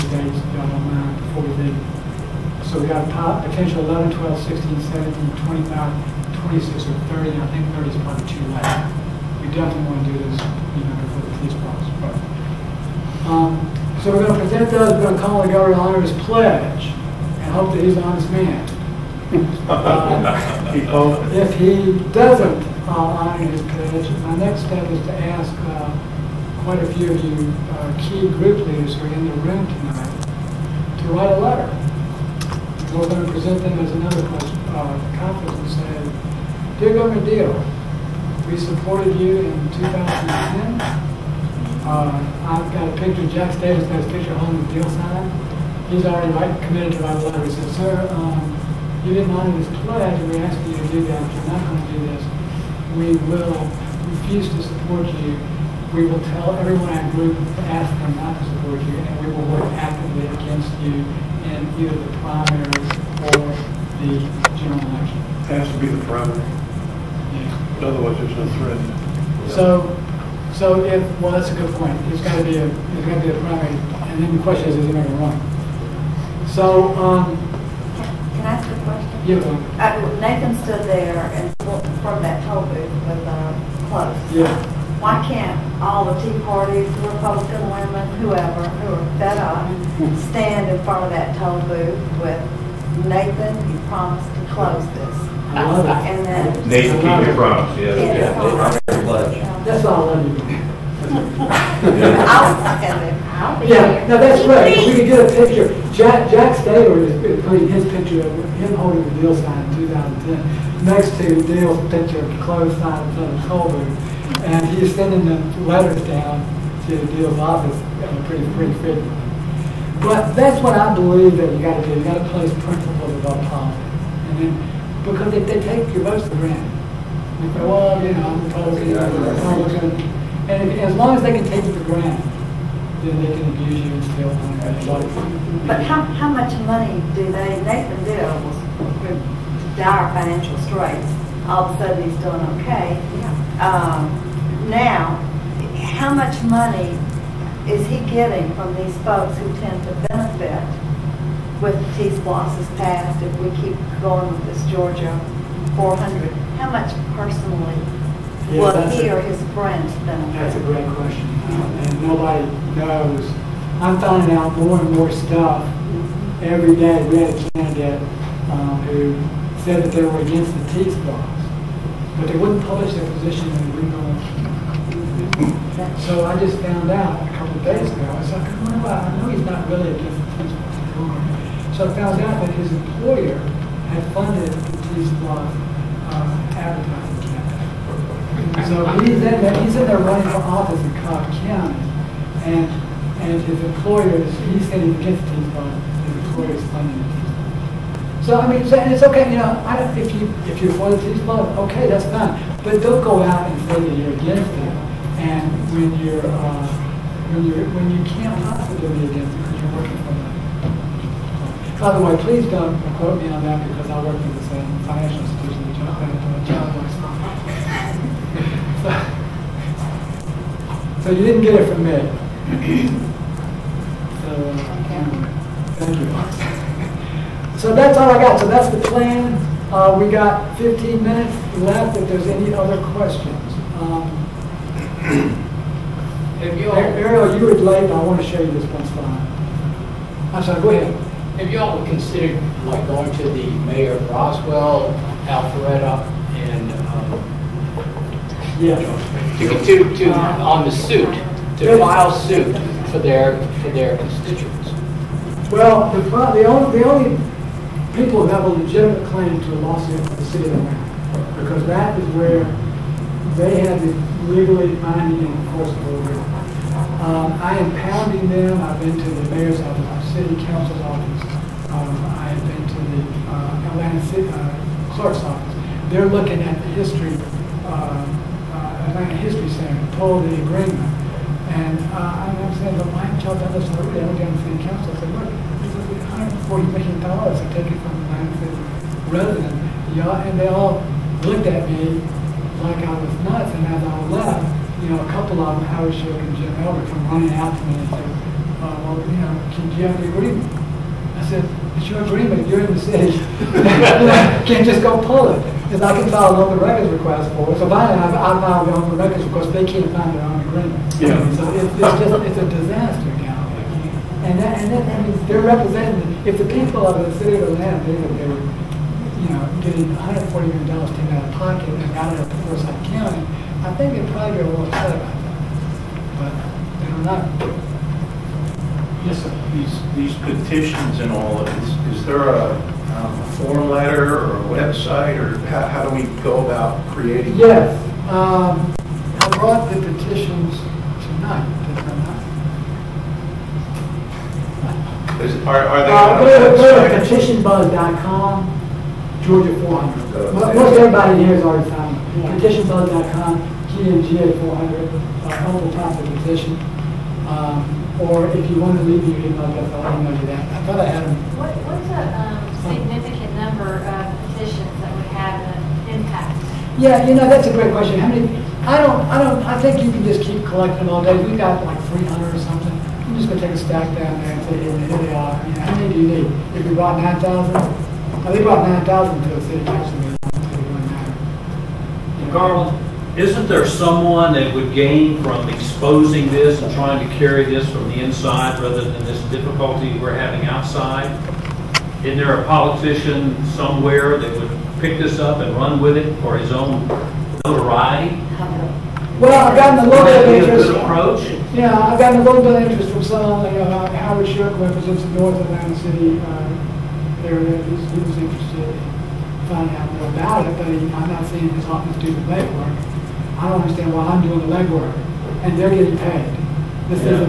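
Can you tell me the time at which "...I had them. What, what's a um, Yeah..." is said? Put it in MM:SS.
06:00.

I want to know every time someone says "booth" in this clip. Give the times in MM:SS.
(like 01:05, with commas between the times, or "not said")
01:22, 01:31.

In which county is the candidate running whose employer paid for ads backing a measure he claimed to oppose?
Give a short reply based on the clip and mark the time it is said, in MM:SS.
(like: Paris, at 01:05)
Cobb County, at 03:11.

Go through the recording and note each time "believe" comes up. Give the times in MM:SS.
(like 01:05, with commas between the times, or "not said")
02:00.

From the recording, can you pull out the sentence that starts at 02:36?
How much personally yeah, was he a, or his That's a great question, uh, and nobody knows.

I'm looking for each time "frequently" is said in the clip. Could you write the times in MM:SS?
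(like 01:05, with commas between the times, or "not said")
01:58.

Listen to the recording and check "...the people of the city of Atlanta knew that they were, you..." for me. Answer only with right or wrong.
right.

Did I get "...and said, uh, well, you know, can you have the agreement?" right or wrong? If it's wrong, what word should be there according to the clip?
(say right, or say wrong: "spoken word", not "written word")
right.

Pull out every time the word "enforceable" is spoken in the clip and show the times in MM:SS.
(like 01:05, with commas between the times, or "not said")
04:25.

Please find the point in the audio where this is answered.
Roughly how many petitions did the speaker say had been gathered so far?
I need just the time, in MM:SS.
06:11.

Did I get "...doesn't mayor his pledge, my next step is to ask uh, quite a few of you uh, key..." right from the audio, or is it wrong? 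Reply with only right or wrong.
wrong.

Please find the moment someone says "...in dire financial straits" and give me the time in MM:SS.
02:19.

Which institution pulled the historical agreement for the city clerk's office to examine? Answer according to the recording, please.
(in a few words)
Atlanta History Center.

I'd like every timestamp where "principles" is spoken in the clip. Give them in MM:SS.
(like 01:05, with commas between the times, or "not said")
02:02.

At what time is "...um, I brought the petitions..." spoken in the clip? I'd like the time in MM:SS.
05:38.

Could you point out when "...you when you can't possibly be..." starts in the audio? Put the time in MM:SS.
03:27.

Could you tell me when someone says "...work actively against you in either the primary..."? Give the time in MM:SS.
00:59.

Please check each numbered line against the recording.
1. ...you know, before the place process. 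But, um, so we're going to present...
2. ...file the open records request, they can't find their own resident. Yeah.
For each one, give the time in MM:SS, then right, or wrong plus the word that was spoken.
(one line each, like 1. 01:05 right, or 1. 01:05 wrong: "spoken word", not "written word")
1. 00:10 wrong: "police", not "place"
2. 05:08 wrong: "agreement", not "resident".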